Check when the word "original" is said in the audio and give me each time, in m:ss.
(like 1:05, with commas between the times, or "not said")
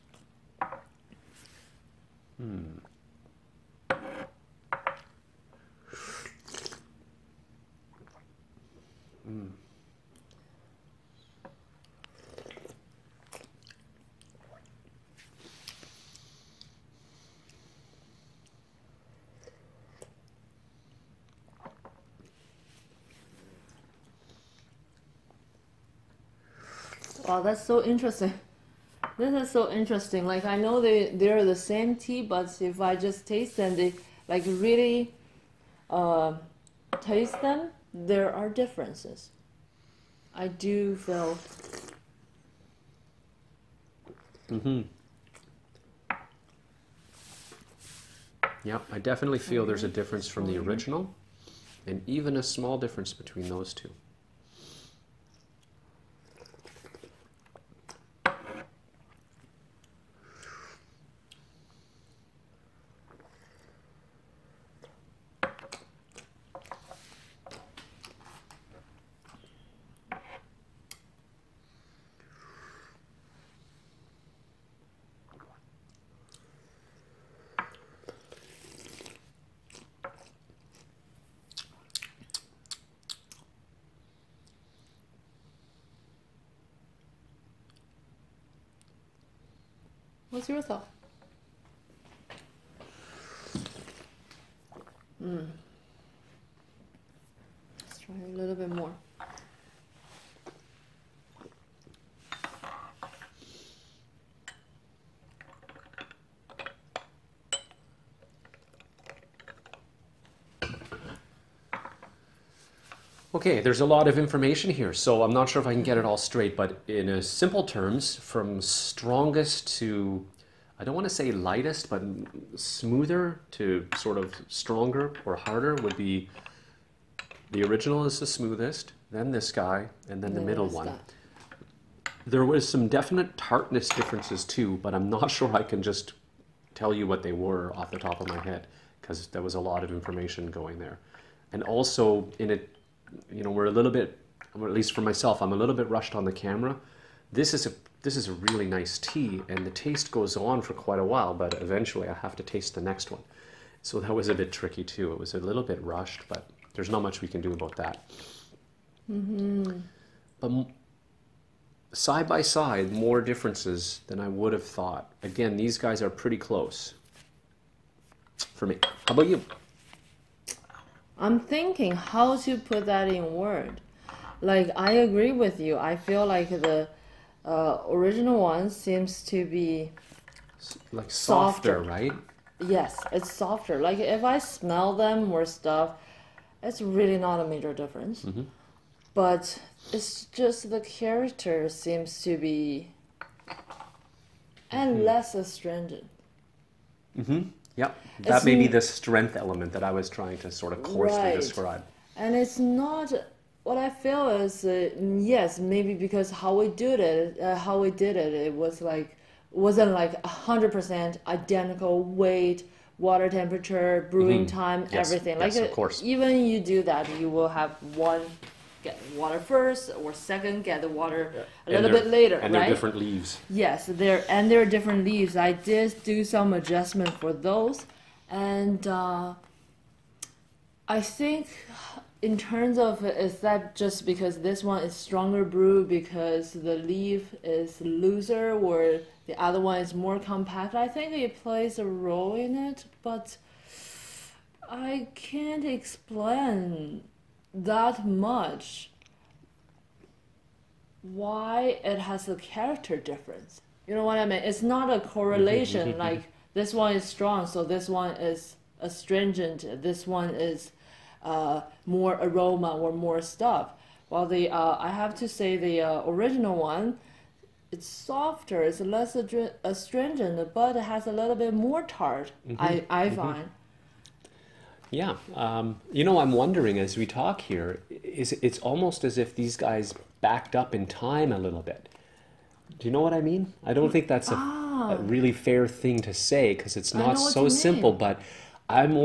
0:50, 2:07, 2:57, 4:26.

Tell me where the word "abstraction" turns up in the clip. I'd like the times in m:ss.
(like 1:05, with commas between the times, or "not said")
not said.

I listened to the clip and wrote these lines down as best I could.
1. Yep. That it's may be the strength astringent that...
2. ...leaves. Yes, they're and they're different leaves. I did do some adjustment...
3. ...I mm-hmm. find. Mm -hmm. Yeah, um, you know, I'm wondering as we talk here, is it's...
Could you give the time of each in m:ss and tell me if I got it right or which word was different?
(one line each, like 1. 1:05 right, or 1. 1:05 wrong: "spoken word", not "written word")
1. 3:17 wrong: "element", not "astringent"
2. 3:42 right
3. 4:32 right.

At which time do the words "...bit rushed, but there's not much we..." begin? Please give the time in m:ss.
2:35.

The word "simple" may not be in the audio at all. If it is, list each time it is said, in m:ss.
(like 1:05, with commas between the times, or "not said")
1:57, 4:47.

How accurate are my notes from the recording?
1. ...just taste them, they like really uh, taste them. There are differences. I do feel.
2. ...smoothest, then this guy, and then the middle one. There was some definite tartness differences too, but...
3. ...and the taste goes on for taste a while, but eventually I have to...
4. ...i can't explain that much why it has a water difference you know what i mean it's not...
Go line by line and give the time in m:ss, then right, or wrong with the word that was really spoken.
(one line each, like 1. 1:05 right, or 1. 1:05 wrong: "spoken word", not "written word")
1. 0:32 right
2. 2:08 right
3. 2:29 wrong: "quite", not "taste"
4. 4:04 wrong: "character", not "water".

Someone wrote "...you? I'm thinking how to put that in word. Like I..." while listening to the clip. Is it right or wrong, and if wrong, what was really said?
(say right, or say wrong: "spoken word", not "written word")
right.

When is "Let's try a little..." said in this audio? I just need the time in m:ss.
1:37.